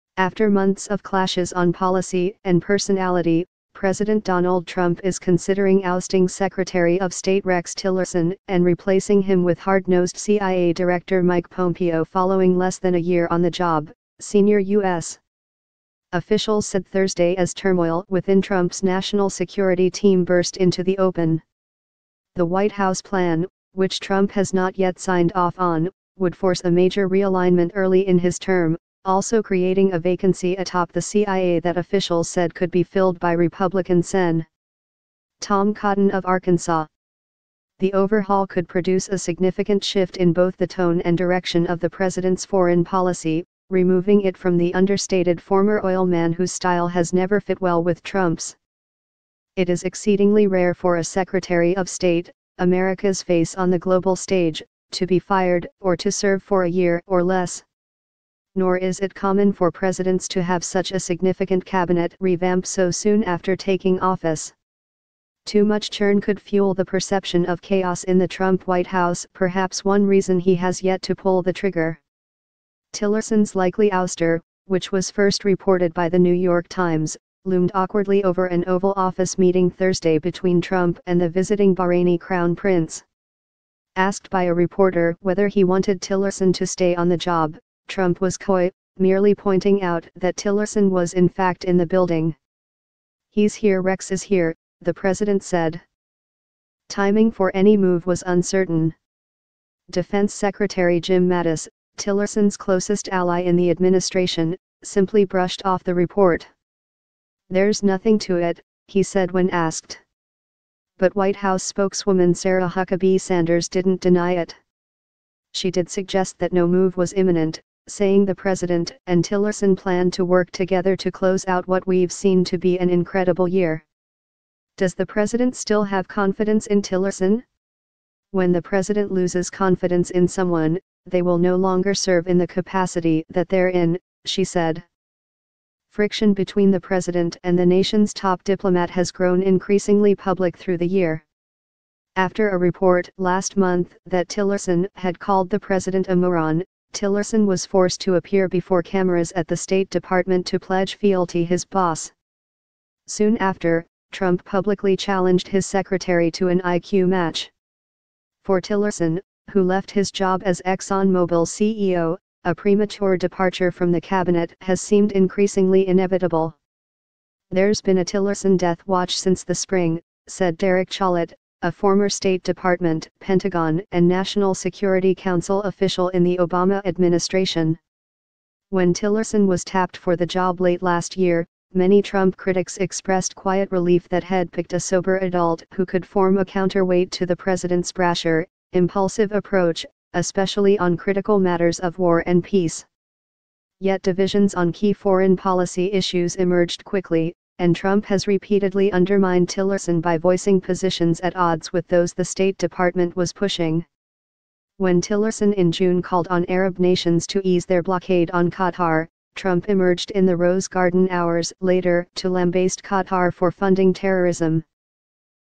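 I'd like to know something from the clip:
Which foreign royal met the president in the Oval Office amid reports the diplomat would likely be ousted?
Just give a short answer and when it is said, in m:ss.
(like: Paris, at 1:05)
Bahraini Crown Prince, at 1:21.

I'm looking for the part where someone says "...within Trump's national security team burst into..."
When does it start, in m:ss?
0:18.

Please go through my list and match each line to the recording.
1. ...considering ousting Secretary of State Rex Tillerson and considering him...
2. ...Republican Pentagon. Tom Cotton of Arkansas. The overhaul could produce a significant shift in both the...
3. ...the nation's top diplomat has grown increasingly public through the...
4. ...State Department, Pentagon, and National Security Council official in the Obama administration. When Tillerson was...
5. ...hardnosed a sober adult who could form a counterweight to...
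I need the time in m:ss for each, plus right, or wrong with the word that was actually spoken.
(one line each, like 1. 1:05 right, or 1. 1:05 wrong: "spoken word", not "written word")
1. 0:05 wrong: "replacing", not "considering"
2. 0:33 wrong: "Sen", not "Pentagon"
3. 2:17 right
4. 2:52 right
5. 3:04 wrong: "picked", not "hardnosed".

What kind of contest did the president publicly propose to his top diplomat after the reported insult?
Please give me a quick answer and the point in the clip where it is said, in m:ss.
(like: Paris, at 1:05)
IQ match, at 2:36.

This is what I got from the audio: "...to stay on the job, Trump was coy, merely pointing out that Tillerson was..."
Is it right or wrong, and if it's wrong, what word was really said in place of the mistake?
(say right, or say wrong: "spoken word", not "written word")
right.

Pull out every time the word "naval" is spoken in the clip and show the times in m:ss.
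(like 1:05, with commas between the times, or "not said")
not said.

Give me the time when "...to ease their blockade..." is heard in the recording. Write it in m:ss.
3:27.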